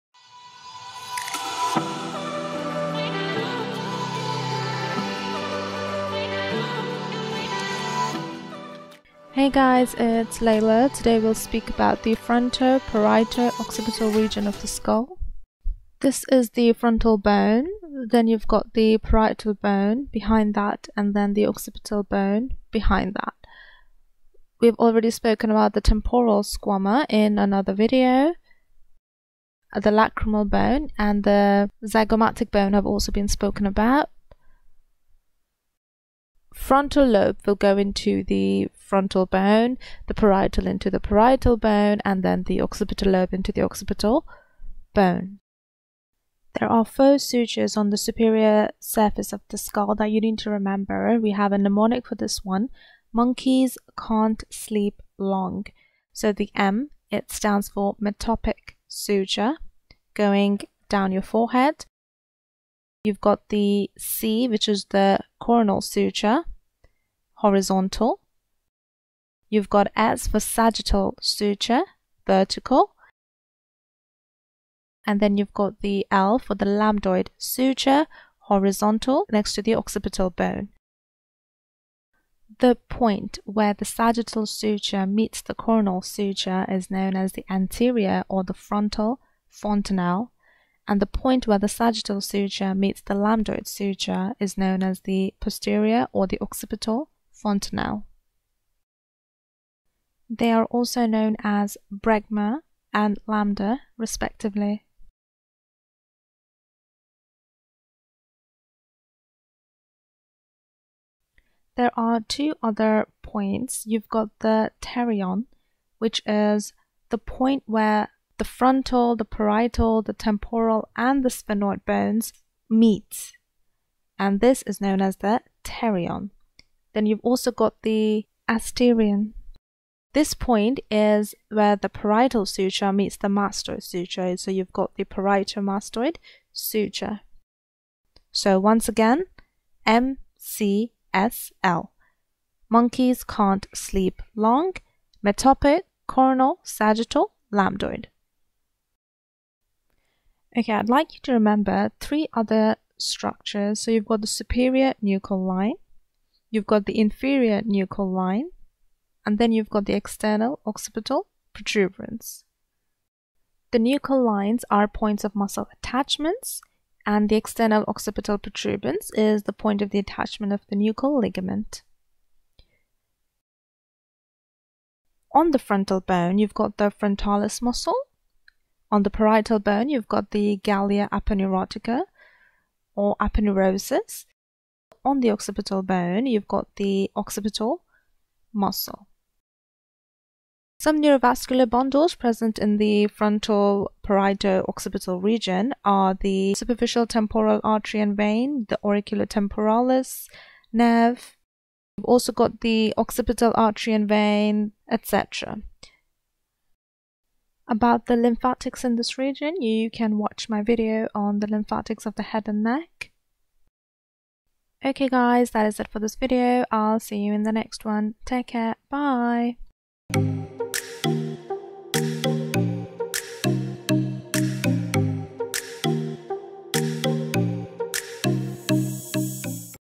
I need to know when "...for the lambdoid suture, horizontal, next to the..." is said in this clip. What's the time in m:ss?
1:16.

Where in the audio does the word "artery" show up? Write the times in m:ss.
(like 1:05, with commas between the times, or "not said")
3:17, 3:23.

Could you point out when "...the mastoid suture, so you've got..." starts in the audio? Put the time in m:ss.
2:13.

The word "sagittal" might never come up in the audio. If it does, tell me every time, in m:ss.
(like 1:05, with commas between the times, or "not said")
1:10, 1:23, 1:31, 2:26.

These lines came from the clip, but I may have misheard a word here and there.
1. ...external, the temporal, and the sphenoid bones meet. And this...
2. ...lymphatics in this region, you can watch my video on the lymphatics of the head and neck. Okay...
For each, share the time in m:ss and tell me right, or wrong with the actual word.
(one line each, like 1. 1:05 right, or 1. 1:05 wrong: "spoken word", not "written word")
1. 1:59 wrong: "parietal", not "external"
2. 3:28 right.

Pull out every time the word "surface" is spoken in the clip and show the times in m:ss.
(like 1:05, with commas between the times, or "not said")
0:48.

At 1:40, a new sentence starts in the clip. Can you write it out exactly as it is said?
They are also known as Bregma and Lambda, respectively.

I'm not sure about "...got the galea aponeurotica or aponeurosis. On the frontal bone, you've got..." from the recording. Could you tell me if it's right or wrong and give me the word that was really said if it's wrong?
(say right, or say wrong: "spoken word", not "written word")
wrong: "occipital", not "frontal".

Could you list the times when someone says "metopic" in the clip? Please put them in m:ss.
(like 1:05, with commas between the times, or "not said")
0:57, 2:25.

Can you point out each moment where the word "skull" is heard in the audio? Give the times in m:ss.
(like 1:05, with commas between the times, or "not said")
0:14, 0:49.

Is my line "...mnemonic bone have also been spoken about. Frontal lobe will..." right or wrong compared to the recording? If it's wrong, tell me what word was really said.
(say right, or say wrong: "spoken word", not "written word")
wrong: "zygomatic", not "mnemonic".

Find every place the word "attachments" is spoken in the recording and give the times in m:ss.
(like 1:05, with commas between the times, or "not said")
2:45, 2:49.